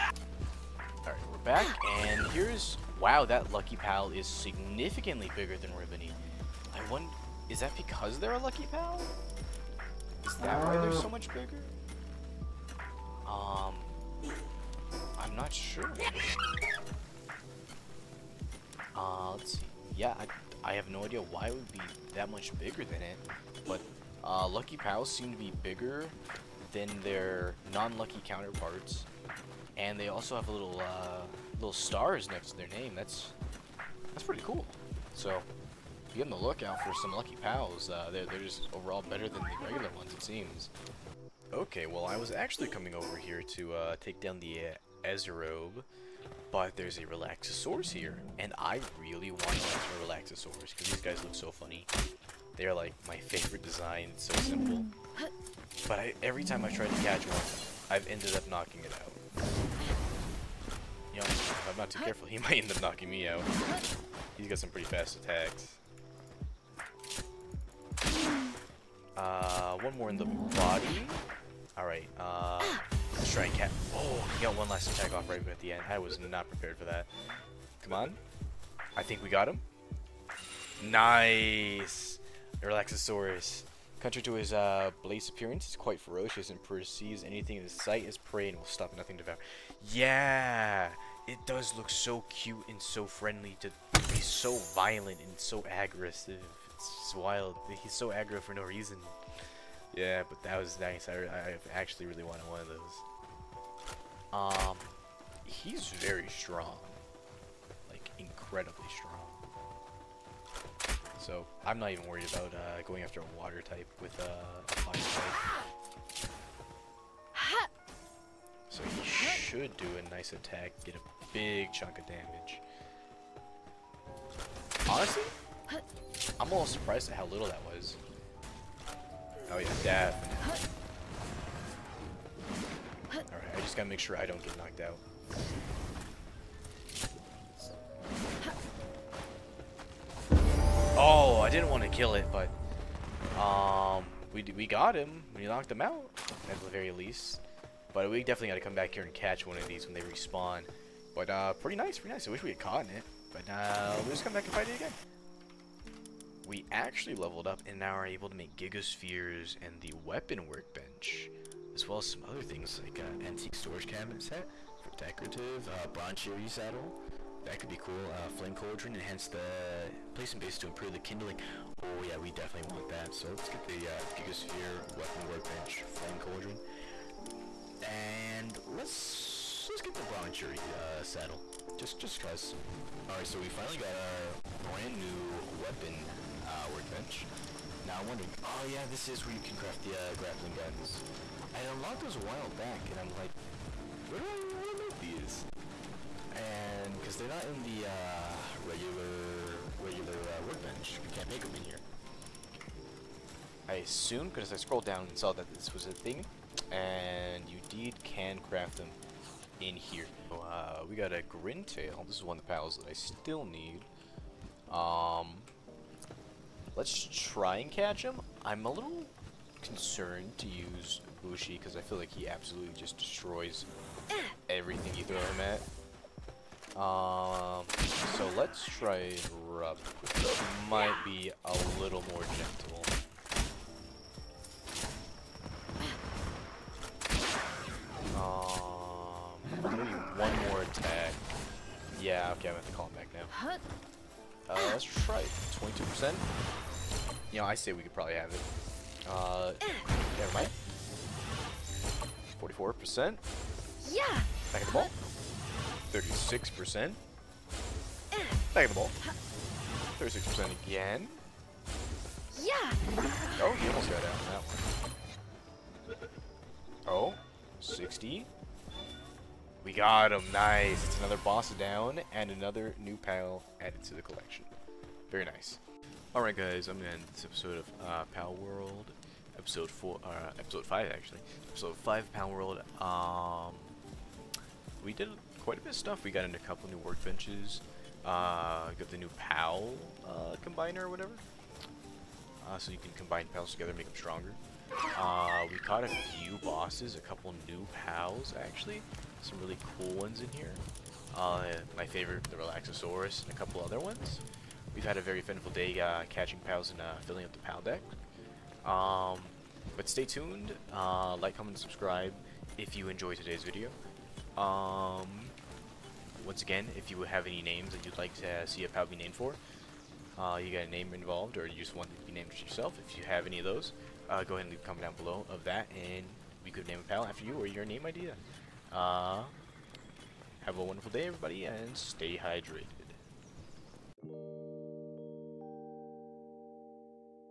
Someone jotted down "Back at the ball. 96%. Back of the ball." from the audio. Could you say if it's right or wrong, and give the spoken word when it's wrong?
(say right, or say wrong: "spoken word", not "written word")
wrong: "36", not "96".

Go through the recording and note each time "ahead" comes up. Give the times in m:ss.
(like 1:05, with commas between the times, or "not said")
5:24.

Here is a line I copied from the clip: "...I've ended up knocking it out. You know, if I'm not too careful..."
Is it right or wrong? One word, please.
right.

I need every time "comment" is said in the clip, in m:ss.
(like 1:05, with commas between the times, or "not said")
5:11, 5:24.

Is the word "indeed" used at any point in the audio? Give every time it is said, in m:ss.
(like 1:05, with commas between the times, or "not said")
3:27.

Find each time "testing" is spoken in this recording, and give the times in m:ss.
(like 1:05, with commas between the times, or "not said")
not said.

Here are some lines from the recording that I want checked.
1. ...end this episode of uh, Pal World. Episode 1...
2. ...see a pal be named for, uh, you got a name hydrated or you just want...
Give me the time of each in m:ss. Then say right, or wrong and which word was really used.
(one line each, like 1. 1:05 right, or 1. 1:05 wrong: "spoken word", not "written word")
1. 4:36 wrong: "4", not "1"
2. 5:18 wrong: "involved", not "hydrated".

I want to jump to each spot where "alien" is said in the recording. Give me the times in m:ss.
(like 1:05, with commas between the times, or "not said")
not said.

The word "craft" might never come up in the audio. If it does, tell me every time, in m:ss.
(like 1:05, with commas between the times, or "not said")
3:09, 3:28.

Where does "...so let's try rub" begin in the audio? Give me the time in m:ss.
3:48.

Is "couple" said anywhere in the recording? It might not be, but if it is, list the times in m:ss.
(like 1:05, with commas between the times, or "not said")
4:46, 4:57, 5:03.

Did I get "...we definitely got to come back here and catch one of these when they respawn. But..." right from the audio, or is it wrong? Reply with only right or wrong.
right.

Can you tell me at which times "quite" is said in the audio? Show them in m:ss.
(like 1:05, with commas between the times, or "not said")
1:25, 4:45.